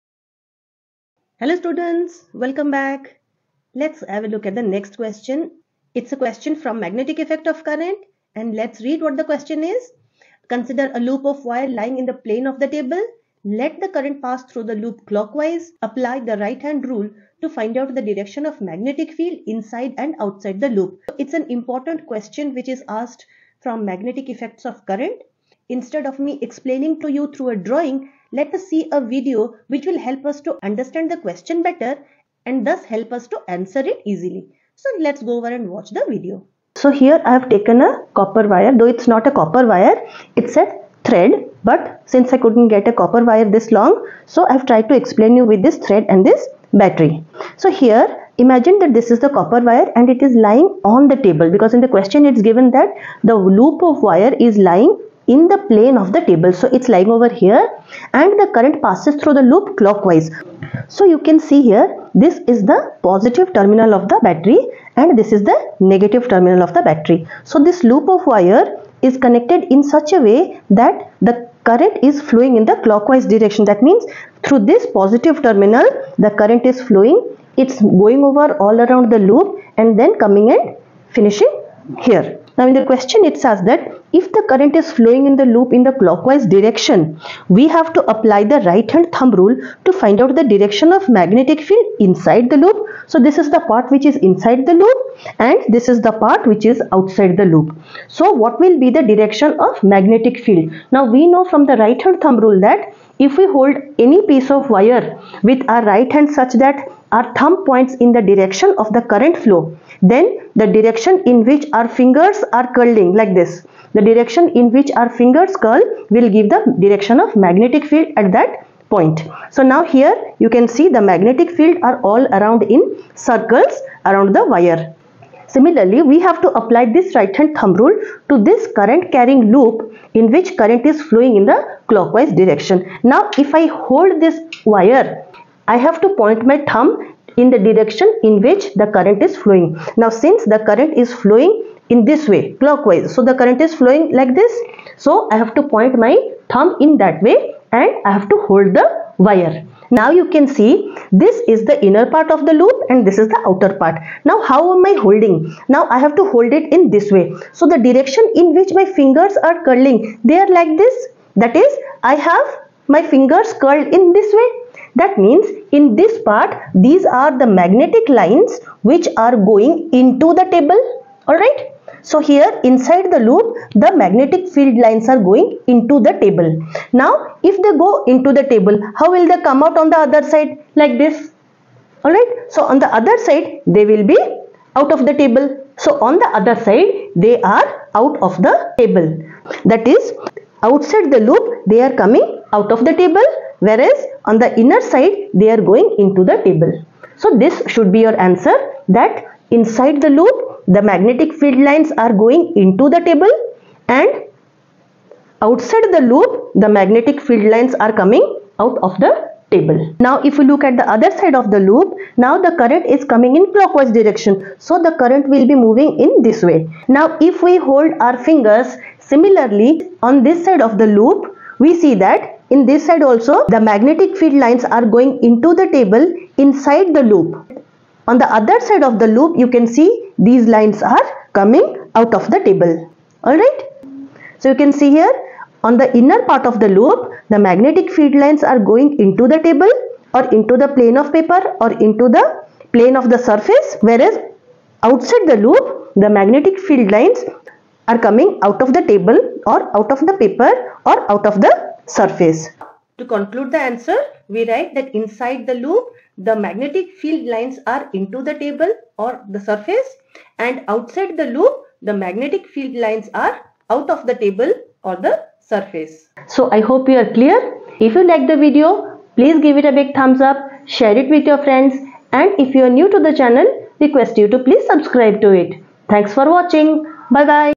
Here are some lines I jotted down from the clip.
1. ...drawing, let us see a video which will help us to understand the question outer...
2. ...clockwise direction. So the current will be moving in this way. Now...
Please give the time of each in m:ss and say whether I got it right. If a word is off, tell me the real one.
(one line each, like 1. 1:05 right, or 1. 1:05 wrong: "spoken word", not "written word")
1. 0:27 wrong: "better", not "outer"
2. 3:33 right.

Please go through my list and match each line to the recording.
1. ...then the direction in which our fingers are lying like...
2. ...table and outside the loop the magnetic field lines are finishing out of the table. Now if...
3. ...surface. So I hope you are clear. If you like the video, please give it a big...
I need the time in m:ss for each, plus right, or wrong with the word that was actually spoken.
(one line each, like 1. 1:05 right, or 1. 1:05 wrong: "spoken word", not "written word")
1. 1:50 wrong: "curling", not "lying"
2. 3:23 wrong: "coming", not "finishing"
3. 4:25 right.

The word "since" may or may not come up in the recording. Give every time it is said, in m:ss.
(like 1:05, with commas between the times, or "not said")
0:42, 2:20.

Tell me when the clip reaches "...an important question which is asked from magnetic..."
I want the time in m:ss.
0:21.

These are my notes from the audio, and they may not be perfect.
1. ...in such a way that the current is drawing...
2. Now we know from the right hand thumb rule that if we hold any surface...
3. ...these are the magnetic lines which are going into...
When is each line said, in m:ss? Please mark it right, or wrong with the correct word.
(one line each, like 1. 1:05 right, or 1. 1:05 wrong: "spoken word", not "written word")
1. 1:09 wrong: "flowing", not "drawing"
2. 1:40 wrong: "piece", not "surface"
3. 2:46 right.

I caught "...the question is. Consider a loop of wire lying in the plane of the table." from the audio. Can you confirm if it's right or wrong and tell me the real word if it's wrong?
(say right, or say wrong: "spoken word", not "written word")
right.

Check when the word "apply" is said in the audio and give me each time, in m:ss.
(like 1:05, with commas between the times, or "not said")
0:15, 1:28, 2:06.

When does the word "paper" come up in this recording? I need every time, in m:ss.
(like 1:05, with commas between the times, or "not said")
4:01, 4:10.